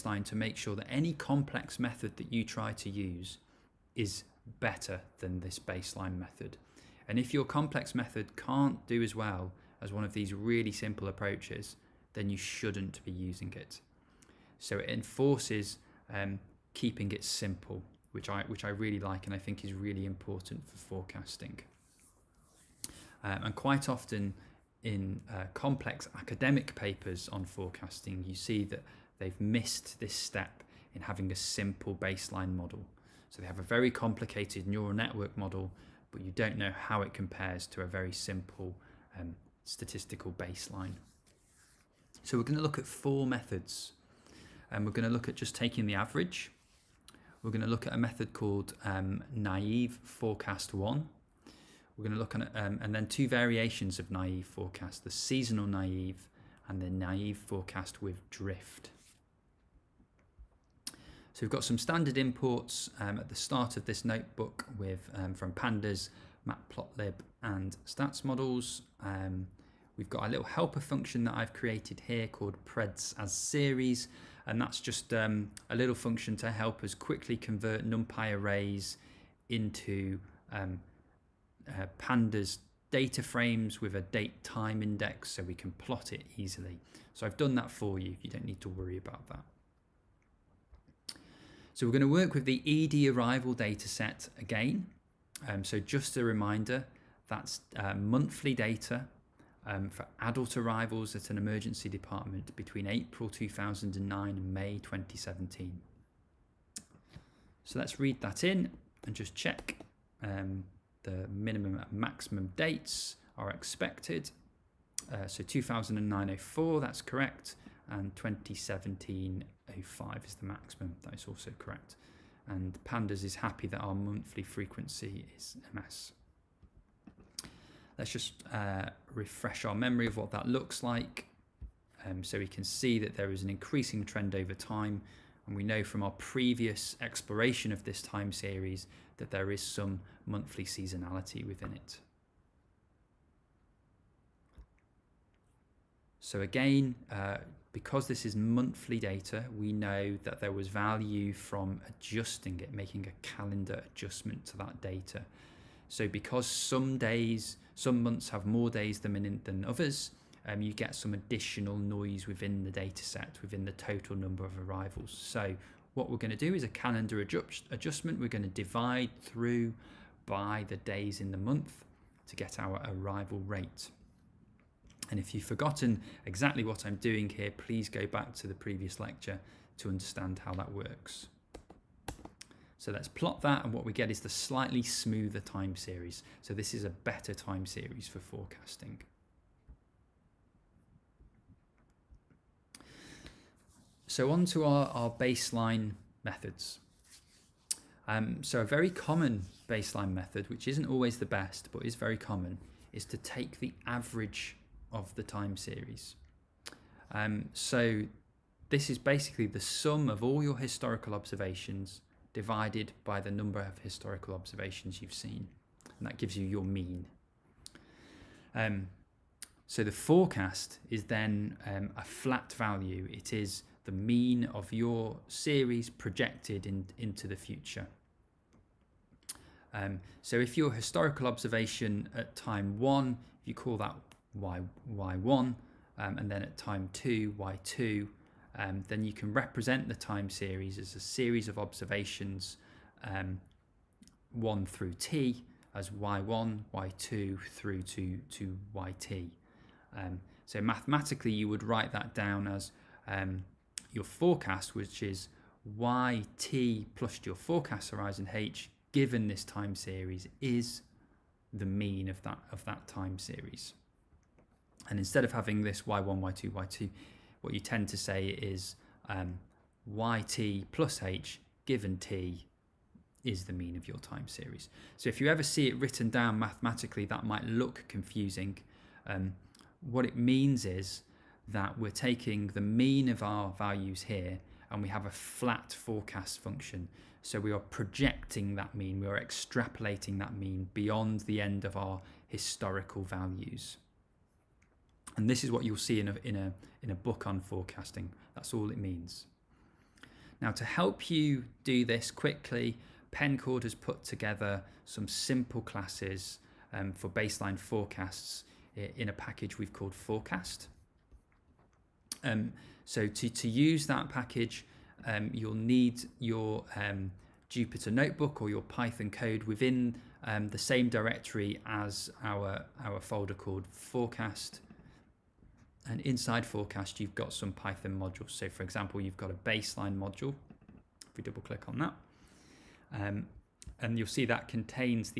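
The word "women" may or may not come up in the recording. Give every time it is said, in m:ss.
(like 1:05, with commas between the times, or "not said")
not said.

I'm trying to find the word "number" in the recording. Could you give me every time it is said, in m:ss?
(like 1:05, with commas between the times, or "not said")
2:44, 3:33.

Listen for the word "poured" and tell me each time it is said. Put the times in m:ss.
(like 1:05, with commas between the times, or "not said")
not said.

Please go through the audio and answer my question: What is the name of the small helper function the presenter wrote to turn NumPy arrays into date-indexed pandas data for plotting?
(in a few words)
preds as series.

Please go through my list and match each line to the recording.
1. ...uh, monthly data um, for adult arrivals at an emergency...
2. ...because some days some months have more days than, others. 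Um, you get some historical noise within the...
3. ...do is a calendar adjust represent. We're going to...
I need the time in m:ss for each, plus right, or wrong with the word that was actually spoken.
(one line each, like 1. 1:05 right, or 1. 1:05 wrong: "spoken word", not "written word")
1. 1:37 right
2. 2:36 wrong: "additional", not "historical"
3. 2:46 wrong: "adjustment", not "represent".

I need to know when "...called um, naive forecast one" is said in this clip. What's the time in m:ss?
0:48.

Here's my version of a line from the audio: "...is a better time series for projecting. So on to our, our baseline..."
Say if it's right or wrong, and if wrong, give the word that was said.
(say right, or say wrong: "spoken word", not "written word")
wrong: "forecasting", not "projecting".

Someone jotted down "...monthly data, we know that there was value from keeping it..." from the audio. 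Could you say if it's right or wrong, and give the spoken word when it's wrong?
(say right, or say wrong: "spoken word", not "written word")
wrong: "adjusting", not "keeping".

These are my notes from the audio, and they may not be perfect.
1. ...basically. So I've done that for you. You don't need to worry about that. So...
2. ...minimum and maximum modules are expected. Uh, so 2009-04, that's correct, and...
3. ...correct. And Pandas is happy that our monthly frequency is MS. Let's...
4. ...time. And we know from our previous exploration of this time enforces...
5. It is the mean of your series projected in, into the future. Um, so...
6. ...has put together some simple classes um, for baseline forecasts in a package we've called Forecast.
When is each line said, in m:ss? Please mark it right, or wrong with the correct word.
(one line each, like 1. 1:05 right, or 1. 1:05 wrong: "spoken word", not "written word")
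1. 1:26 wrong: "easily", not "basically"
2. 1:51 wrong: "dates", not "modules"
3. 2:01 right
4. 2:14 wrong: "series", not "enforces"
5. 3:43 right
6. 5:03 right.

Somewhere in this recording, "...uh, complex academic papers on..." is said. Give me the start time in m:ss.
0:25.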